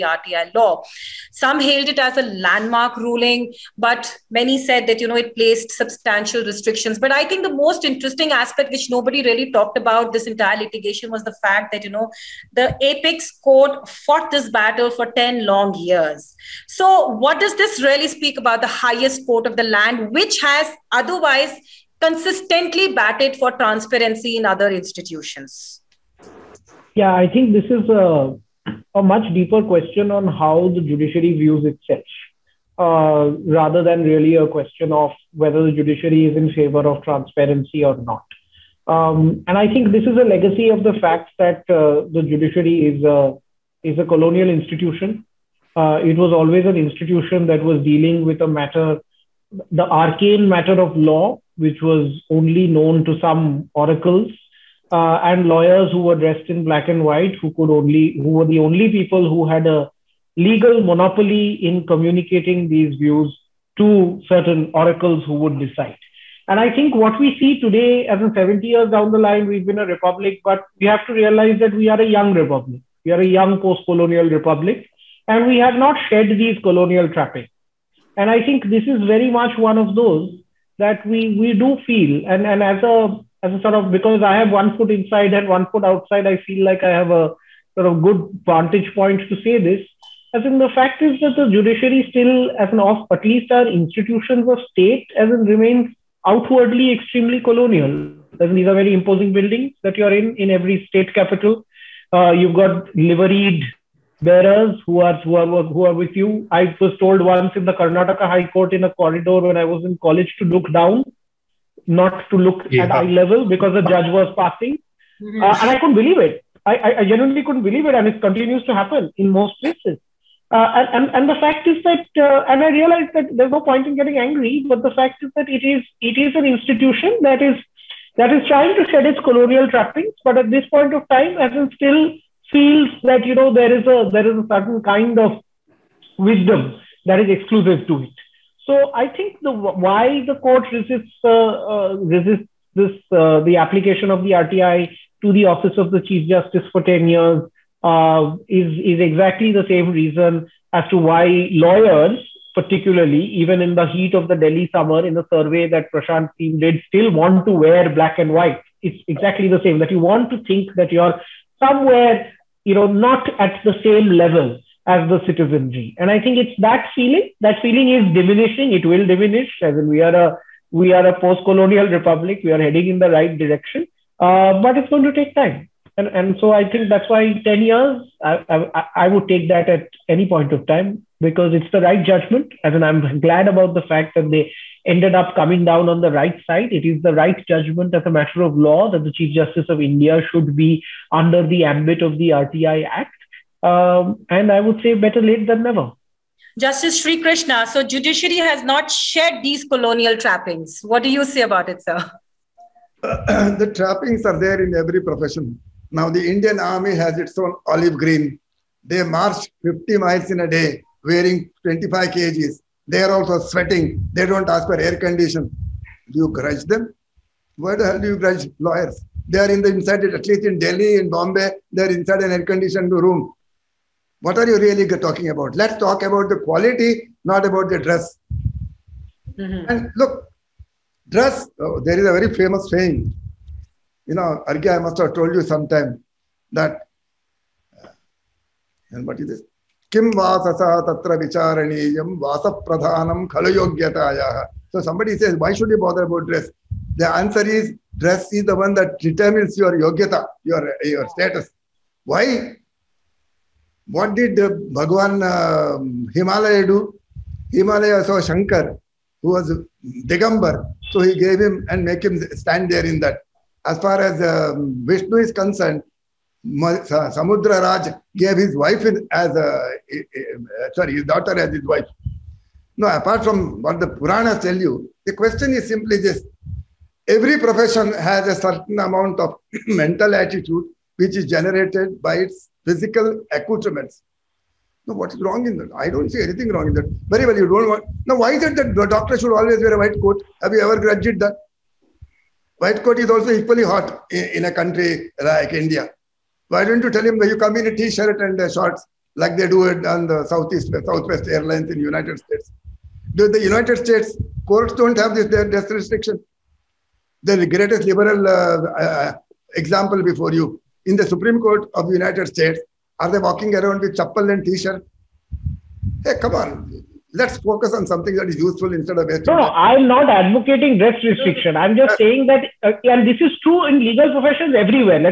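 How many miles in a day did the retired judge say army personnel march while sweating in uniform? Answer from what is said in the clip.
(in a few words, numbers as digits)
50 miles.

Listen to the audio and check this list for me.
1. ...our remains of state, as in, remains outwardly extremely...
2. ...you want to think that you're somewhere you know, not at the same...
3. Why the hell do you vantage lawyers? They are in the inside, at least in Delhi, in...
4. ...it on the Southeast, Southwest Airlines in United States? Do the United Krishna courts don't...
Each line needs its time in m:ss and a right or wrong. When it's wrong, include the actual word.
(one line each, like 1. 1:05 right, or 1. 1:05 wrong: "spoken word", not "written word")
1. 1:33 wrong: "institutions", not "remains"
2. 2:39 right
3. 3:37 wrong: "grudge", not "vantage"
4. 4:59 wrong: "States", not "Krishna".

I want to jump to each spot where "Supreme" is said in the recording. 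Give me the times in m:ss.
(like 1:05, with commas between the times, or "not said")
5:11.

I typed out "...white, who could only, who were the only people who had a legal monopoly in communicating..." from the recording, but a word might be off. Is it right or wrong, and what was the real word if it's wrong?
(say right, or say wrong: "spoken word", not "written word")
right.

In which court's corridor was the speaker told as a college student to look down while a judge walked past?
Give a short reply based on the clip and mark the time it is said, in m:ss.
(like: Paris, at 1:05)
Karnataka High Court, at 1:47.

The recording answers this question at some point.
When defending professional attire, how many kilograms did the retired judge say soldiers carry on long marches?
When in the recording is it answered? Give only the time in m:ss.
3:31.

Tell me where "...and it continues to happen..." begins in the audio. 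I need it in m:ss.
1:57.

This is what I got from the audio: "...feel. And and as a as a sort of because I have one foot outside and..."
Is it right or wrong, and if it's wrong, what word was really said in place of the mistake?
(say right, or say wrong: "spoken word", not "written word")
wrong: "inside", not "outside".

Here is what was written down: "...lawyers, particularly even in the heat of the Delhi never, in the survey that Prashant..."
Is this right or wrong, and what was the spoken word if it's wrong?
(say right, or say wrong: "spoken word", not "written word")
wrong: "summer", not "never".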